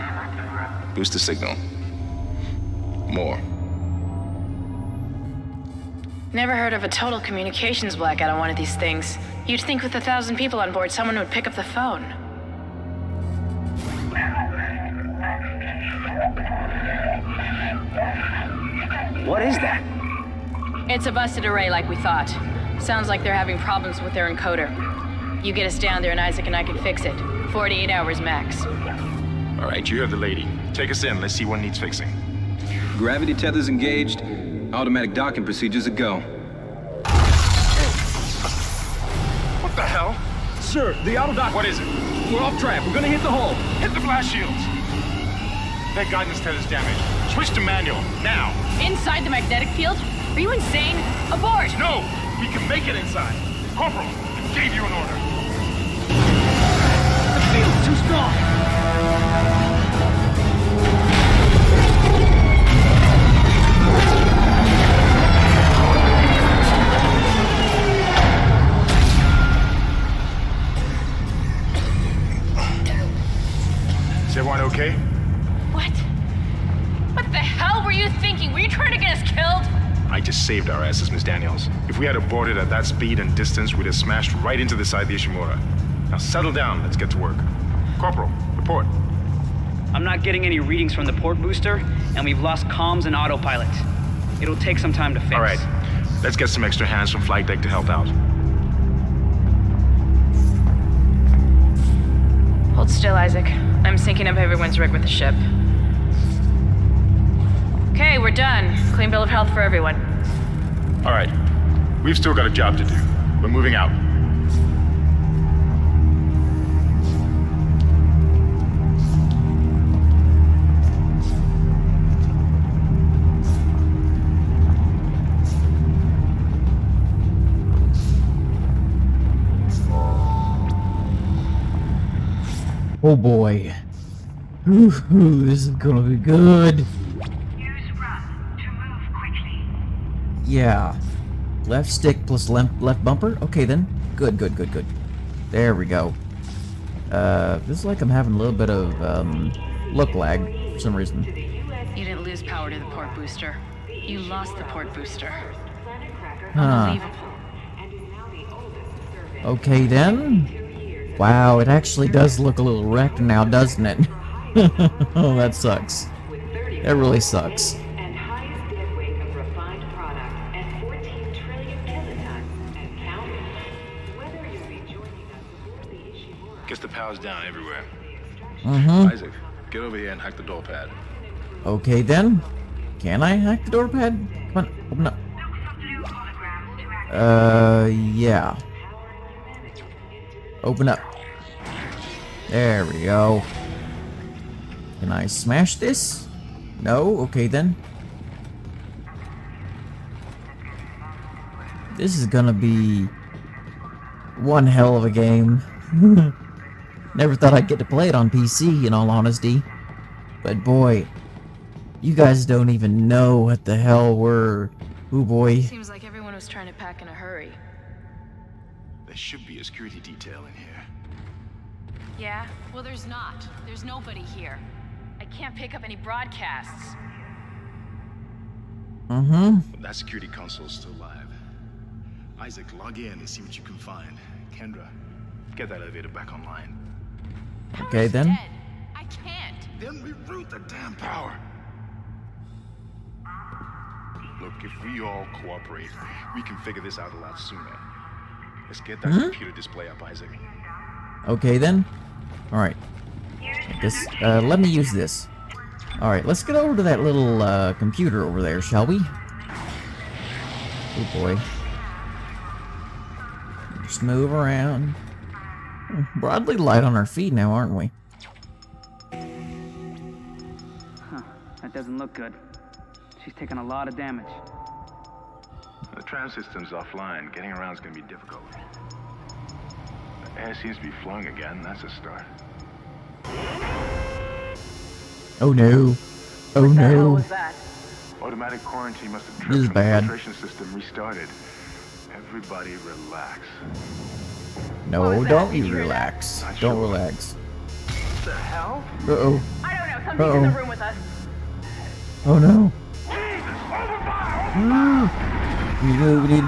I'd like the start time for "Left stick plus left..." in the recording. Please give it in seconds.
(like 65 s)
141 s.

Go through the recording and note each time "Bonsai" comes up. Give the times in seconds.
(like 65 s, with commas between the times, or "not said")
not said.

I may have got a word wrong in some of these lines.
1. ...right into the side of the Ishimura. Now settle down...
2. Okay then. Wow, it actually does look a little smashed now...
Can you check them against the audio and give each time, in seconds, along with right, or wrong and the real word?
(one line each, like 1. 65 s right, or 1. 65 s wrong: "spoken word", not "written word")
1. 84 s right
2. 159 s wrong: "wrecked", not "smashed".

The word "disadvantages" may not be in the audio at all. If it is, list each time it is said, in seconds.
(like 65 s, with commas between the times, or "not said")
not said.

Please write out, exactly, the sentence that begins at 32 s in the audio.
Gravity tethers engaged, automatic docking procedures a go.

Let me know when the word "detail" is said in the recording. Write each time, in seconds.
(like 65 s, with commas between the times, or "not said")
220 s.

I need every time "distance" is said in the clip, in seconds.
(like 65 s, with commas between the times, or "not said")
83 s.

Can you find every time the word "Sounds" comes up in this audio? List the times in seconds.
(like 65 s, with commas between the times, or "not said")
22 s.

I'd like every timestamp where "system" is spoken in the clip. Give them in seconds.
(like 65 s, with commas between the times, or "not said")
276 s, 290 s.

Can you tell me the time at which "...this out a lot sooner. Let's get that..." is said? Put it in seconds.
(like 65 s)
246 s.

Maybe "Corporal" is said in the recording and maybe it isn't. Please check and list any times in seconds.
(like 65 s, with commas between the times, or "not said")
53 s, 87 s.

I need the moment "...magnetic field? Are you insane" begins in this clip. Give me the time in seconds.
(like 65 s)
49 s.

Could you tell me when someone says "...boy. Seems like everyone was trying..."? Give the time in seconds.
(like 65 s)
215 s.